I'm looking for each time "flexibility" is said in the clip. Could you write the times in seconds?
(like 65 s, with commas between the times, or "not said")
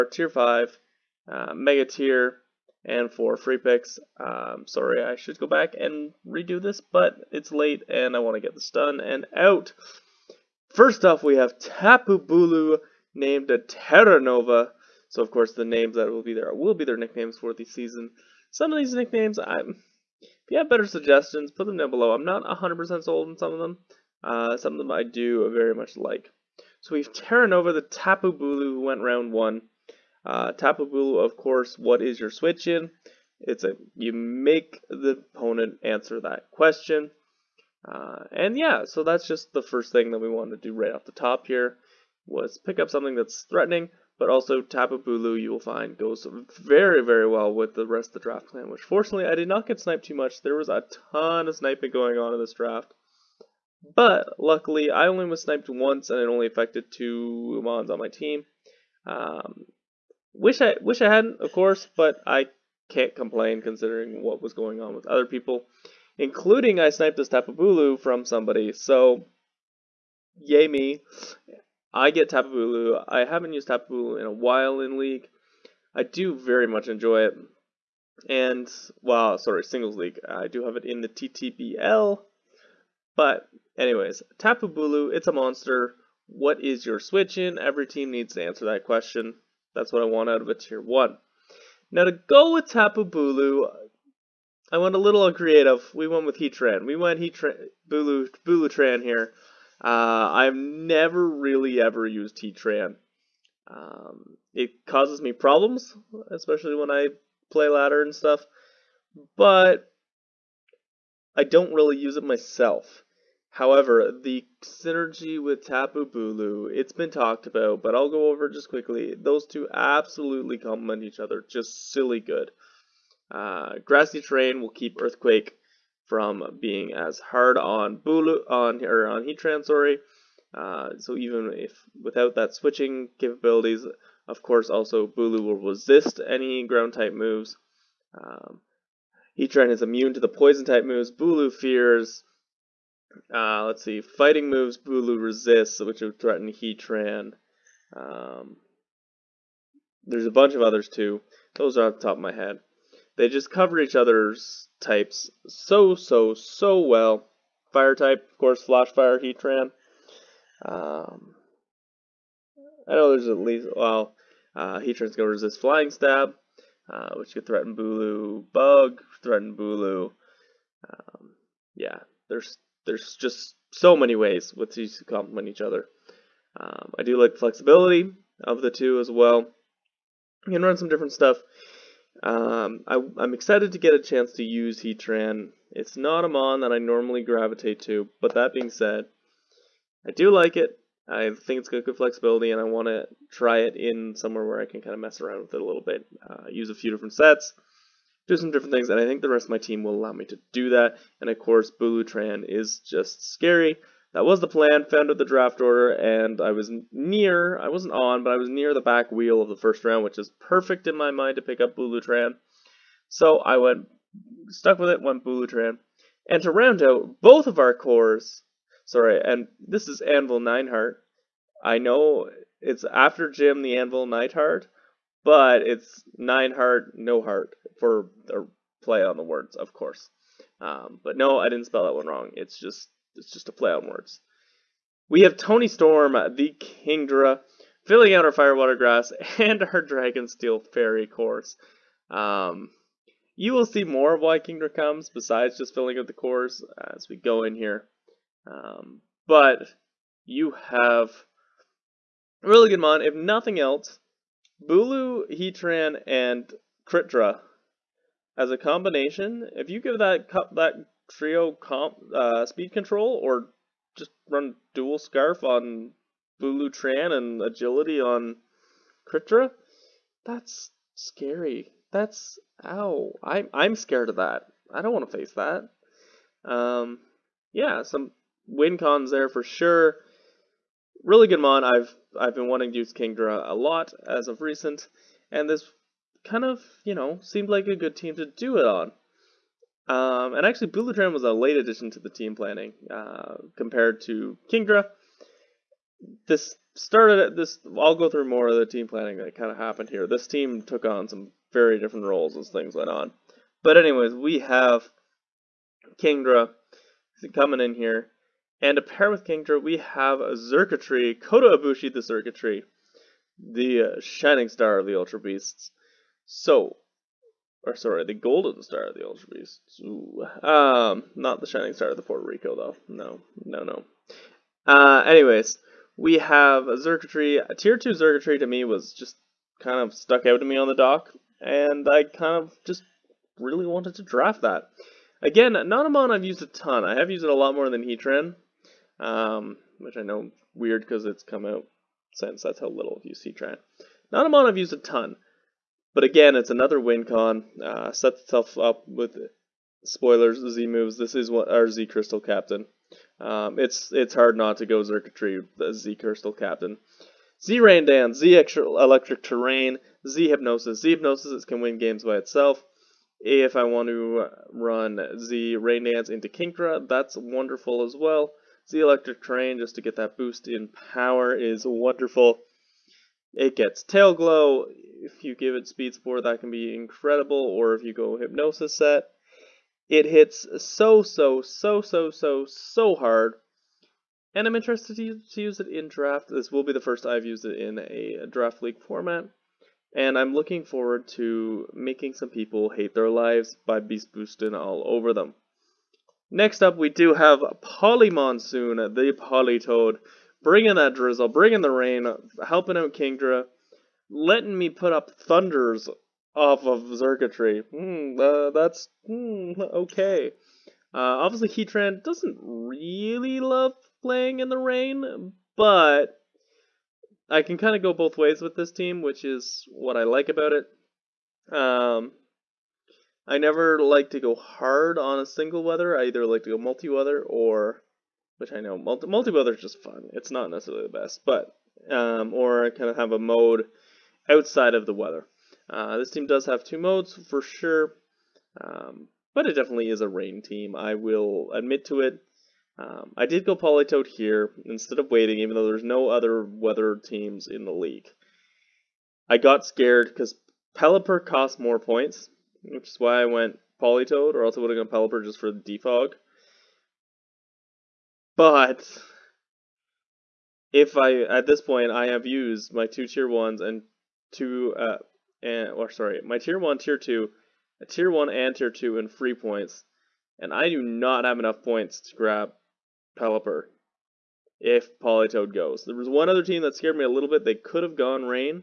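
177 s, 191 s.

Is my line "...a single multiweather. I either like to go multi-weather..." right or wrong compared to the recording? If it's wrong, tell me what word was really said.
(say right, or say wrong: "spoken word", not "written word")
wrong: "weather", not "multiweather".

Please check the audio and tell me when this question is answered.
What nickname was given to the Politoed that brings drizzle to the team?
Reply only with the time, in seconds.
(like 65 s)
397 s.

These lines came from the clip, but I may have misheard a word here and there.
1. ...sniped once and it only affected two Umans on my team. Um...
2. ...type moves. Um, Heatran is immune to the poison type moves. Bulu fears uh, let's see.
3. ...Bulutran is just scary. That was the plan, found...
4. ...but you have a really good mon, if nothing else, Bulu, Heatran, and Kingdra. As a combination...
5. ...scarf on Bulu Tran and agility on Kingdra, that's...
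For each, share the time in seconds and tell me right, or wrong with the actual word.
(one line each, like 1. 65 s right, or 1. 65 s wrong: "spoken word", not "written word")
1. 55 s right
2. 136 s right
3. 201 s right
4. 249 s right
5. 264 s right.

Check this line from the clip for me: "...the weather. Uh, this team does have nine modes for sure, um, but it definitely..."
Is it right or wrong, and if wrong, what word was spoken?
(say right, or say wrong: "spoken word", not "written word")
wrong: "two", not "nine".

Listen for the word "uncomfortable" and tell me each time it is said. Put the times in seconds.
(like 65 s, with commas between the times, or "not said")
not said.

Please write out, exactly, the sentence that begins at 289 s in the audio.
Um, and actually, Bulutran was a late addition to the team planning uh, compared to Kingdra.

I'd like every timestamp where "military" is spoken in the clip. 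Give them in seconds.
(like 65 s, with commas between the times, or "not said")
not said.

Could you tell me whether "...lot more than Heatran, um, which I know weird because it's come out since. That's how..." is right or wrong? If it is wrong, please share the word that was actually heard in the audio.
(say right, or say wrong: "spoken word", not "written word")
right.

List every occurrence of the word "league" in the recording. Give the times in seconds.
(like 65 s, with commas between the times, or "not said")
74 s, 79 s, 388 s, 447 s.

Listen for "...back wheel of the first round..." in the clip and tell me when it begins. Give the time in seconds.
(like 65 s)
208 s.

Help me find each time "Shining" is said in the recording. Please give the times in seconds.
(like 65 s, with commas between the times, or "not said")
313 s, 321 s.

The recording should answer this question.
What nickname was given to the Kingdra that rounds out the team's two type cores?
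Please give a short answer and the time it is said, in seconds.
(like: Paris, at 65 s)
Toni Storm, at 235 s.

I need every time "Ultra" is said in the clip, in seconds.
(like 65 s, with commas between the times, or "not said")
314 s, 319 s.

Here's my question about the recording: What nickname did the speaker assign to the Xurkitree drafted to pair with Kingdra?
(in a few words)
Kota Ibushi.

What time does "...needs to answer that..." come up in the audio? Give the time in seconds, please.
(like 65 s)
88 s.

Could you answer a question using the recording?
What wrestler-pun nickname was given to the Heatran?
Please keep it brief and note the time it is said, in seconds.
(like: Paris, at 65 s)
Anvil Nineheart, at 220 s.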